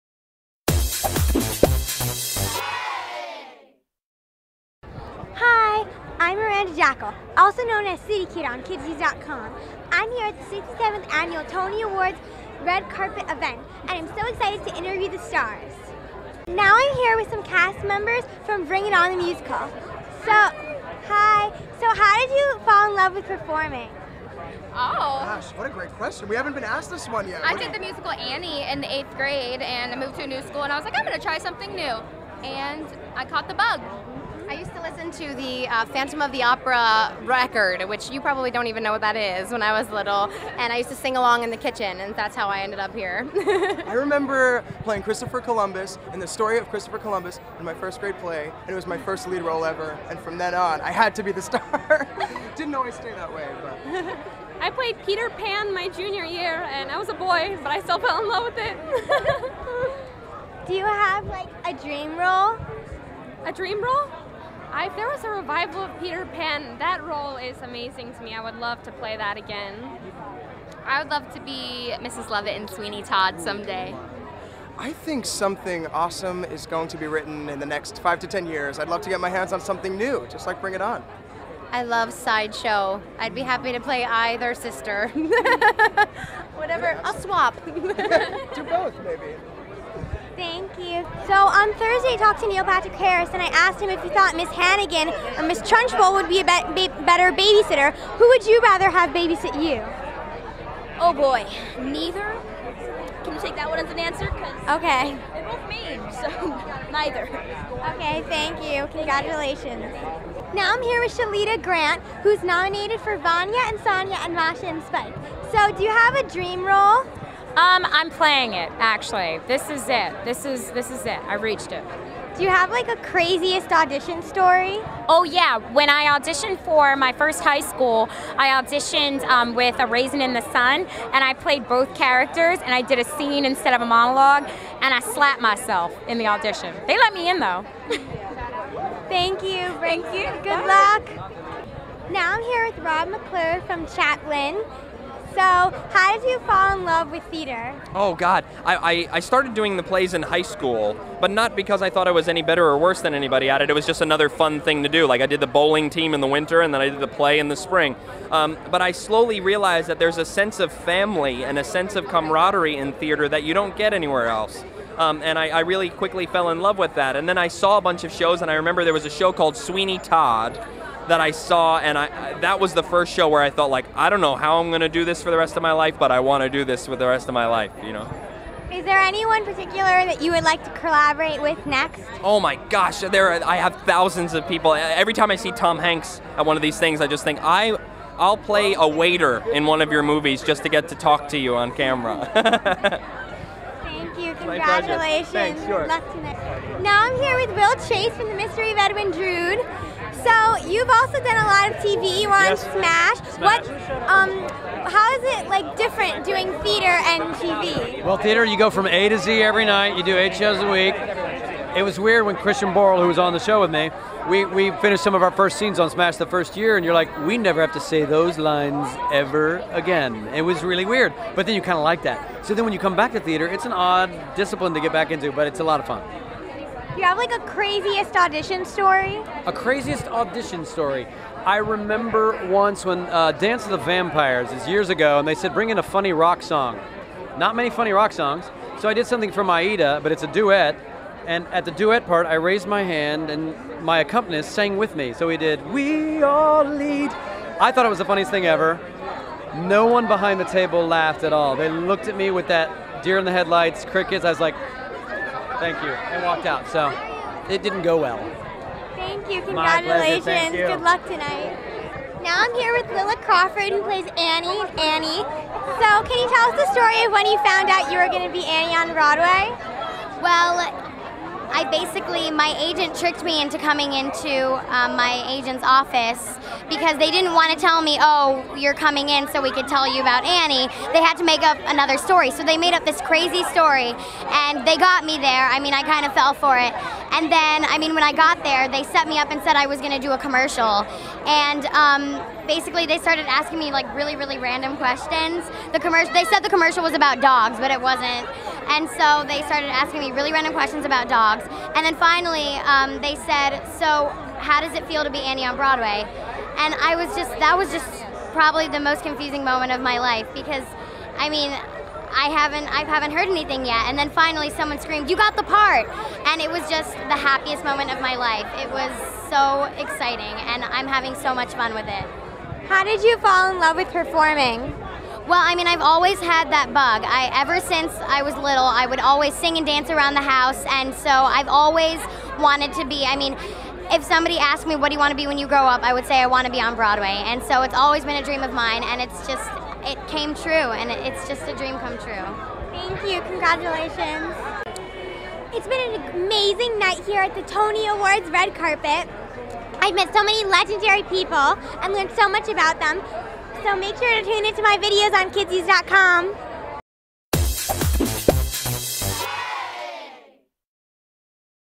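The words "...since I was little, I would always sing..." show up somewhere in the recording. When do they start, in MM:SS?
05:27.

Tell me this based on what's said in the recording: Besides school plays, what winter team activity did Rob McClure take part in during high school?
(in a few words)
bowling.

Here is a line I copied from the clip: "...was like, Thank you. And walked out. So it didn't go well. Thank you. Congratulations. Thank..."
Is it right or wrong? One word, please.
right.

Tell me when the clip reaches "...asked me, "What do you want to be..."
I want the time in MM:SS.
05:34.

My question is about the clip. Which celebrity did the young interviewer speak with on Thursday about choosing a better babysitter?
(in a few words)
Neil Patrick Harris.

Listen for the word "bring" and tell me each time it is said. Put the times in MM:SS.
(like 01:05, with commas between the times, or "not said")
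00:18, 01:20, 03:55.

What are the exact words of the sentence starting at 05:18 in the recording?
It was so exciting and I'm having so much fun with it.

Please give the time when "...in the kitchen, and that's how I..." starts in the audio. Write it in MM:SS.
00:41.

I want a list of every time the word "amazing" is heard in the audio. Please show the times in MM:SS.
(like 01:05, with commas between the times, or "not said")
01:07, 05:46.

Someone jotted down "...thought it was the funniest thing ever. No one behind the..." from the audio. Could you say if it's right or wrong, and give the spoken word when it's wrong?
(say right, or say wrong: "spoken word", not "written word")
right.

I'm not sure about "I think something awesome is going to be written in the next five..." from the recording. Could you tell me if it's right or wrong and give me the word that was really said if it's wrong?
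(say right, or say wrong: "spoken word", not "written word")
right.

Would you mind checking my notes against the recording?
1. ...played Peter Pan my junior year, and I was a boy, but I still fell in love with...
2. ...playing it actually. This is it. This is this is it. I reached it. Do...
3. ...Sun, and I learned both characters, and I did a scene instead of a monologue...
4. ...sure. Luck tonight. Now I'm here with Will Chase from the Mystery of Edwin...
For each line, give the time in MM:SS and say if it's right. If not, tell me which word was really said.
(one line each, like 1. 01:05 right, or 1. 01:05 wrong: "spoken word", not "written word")
1. 00:54 right
2. 01:58 right
3. 02:10 wrong: "played", not "learned"
4. 03:15 right.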